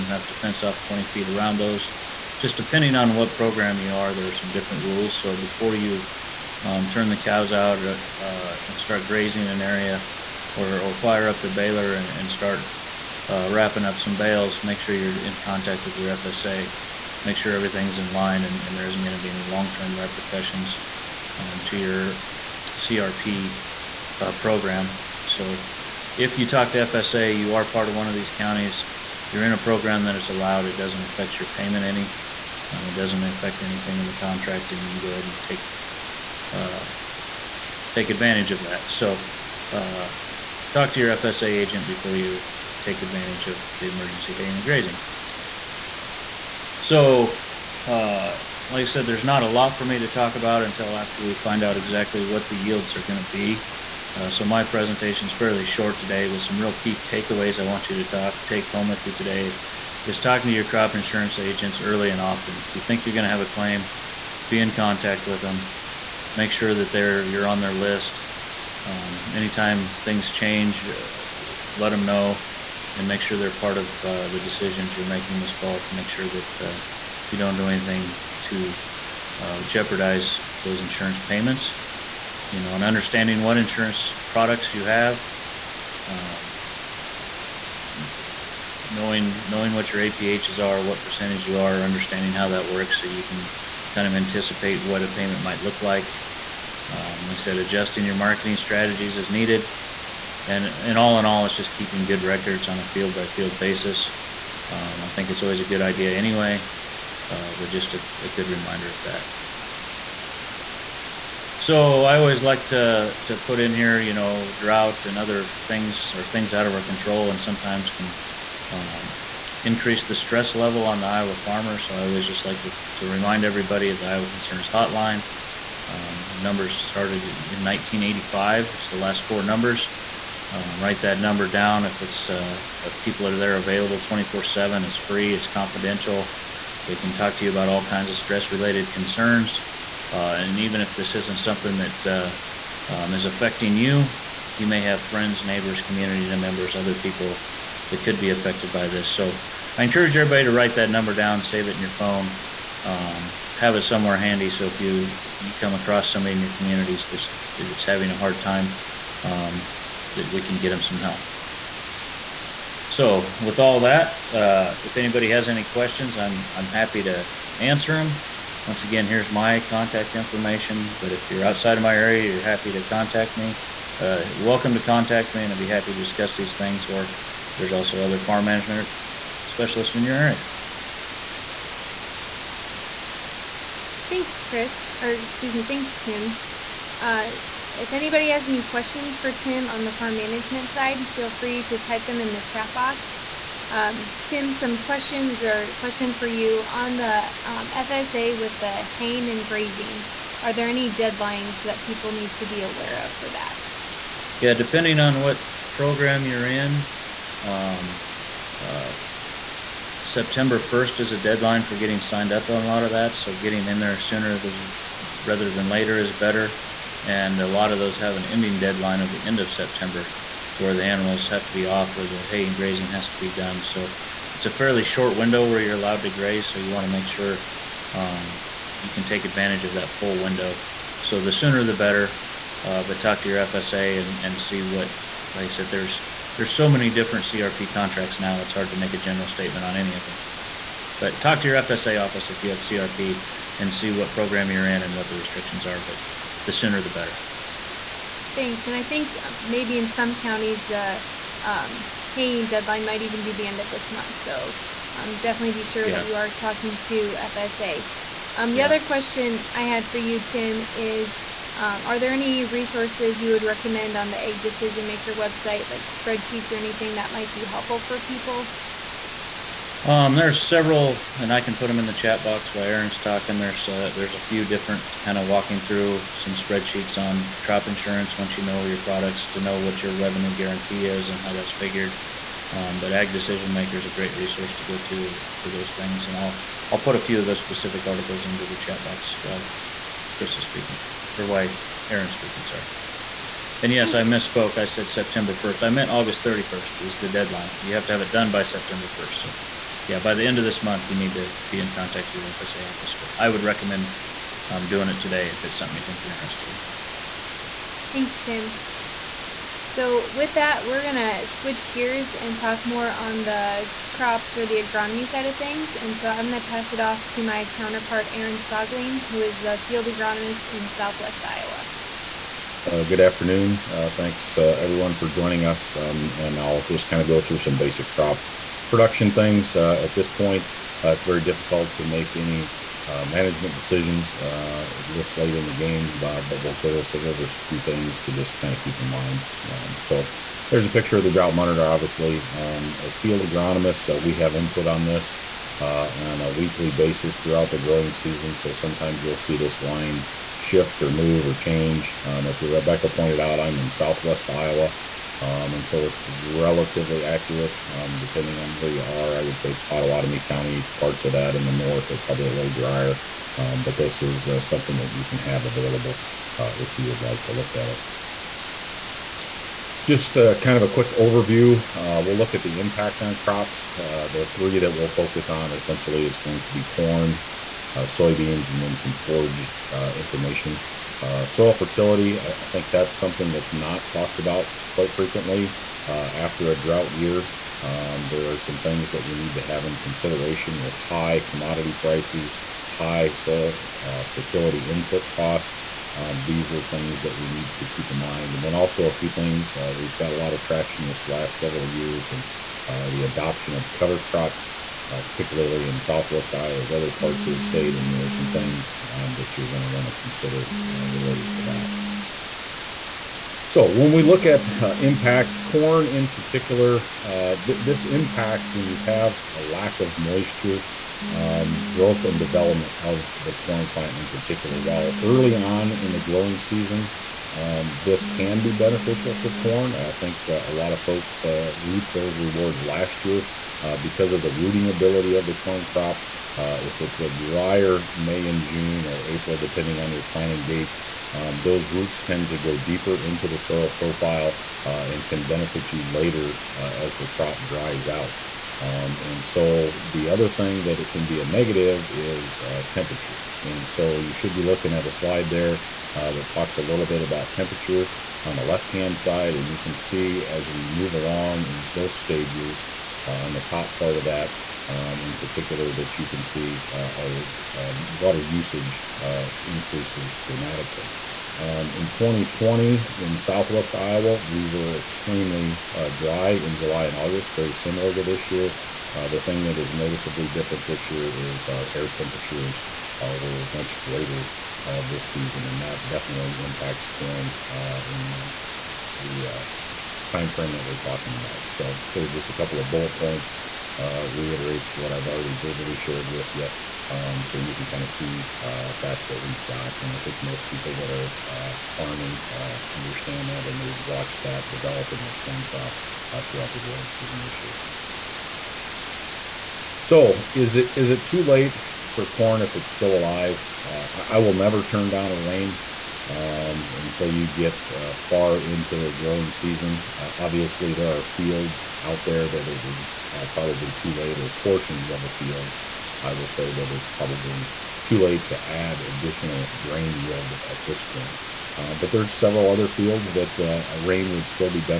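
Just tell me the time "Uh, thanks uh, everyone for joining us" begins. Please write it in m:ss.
5:23.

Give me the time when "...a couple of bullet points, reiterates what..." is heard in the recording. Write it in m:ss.
8:12.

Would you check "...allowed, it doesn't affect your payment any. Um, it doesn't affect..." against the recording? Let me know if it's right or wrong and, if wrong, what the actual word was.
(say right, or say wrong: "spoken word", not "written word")
right.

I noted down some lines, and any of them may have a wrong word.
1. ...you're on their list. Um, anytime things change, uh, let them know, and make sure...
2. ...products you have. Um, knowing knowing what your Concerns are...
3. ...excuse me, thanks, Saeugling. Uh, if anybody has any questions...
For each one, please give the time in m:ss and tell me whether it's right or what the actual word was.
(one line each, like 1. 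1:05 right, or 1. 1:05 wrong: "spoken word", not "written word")
1. 1:07 right
2. 1:24 wrong: "APHs", not "Concerns"
3. 3:05 wrong: "Tim", not "Saeugling".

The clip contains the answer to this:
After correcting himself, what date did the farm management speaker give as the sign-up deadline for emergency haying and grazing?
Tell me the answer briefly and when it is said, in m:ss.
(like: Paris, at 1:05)
August 31st, at 4:55.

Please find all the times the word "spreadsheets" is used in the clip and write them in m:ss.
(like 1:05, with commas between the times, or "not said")
4:25, 4:36.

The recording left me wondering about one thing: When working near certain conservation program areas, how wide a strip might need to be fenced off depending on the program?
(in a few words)
20 feet.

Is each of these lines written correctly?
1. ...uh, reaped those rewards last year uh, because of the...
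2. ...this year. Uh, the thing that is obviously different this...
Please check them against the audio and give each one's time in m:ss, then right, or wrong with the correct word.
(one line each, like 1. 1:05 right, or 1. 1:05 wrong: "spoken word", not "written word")
1. 7:11 right
2. 7:58 wrong: "noticeably", not "obviously".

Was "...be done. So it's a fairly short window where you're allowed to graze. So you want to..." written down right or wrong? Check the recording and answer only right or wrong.
right.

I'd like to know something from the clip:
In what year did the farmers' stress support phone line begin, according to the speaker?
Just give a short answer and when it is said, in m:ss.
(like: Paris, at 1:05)
1985, at 2:07.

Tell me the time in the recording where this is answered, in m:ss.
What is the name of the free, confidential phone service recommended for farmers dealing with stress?
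2:04.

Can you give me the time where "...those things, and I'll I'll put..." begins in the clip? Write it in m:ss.
4:45.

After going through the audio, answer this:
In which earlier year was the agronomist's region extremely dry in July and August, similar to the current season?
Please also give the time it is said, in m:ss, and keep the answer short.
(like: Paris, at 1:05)
2020, at 7:51.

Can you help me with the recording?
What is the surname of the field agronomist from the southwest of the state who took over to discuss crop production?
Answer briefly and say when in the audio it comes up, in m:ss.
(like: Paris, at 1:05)
Saeugling, at 5:18.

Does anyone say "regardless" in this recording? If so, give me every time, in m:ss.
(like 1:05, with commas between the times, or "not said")
not said.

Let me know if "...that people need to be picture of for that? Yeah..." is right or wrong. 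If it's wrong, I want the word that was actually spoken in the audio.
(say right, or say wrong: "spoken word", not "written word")
wrong: "aware", not "picture".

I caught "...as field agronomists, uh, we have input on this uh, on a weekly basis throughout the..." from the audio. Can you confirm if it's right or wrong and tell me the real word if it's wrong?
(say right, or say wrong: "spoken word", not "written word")
right.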